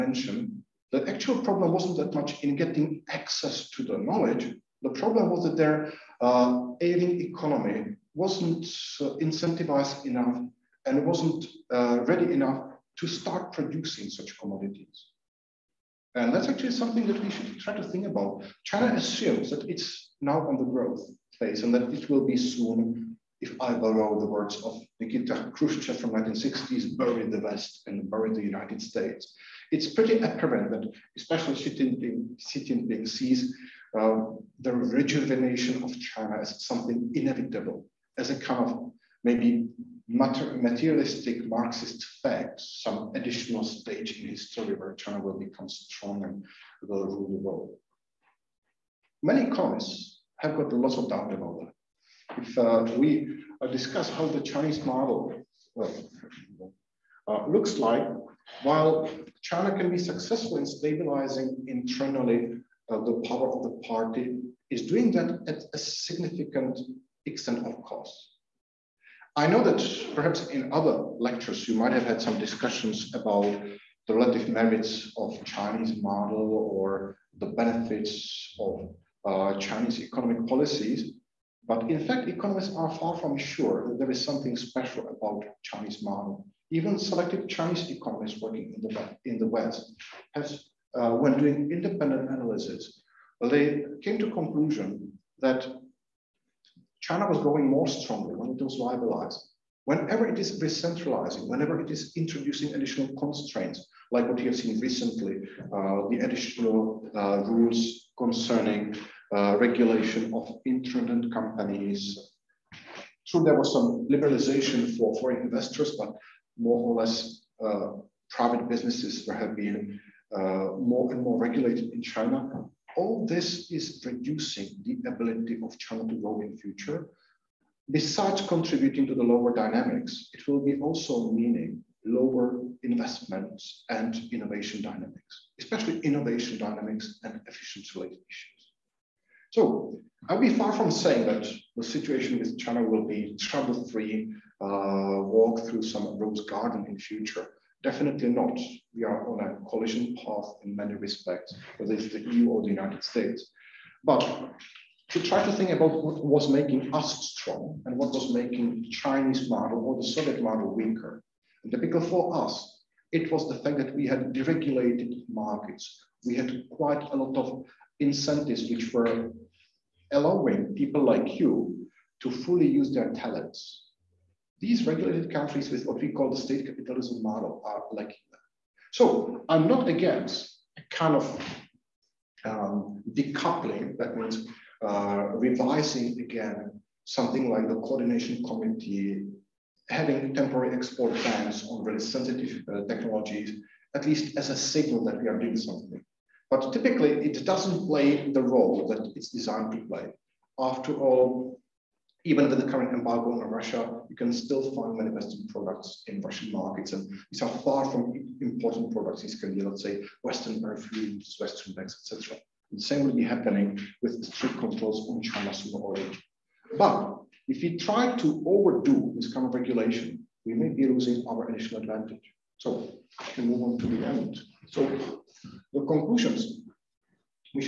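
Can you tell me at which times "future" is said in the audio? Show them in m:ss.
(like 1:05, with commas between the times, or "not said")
2:06, 2:26.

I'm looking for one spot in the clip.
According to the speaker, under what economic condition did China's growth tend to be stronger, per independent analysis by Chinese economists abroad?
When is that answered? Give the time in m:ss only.
1:38.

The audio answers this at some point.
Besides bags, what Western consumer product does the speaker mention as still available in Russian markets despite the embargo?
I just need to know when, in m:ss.
3:30.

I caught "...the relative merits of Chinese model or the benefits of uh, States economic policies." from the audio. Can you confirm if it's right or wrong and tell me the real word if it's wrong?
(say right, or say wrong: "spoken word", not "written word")
wrong: "Chinese", not "States".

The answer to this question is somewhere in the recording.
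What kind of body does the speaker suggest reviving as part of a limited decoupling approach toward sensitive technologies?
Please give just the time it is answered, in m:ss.
3:07.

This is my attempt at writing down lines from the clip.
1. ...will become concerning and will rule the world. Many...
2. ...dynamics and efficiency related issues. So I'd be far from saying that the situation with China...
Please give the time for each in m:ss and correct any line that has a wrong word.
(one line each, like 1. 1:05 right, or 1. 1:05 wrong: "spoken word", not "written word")
1. 0:45 wrong: "strong", not "concerning"
2. 2:16 right.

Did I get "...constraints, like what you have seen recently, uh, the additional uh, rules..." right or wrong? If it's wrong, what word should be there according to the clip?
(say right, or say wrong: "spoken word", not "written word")
right.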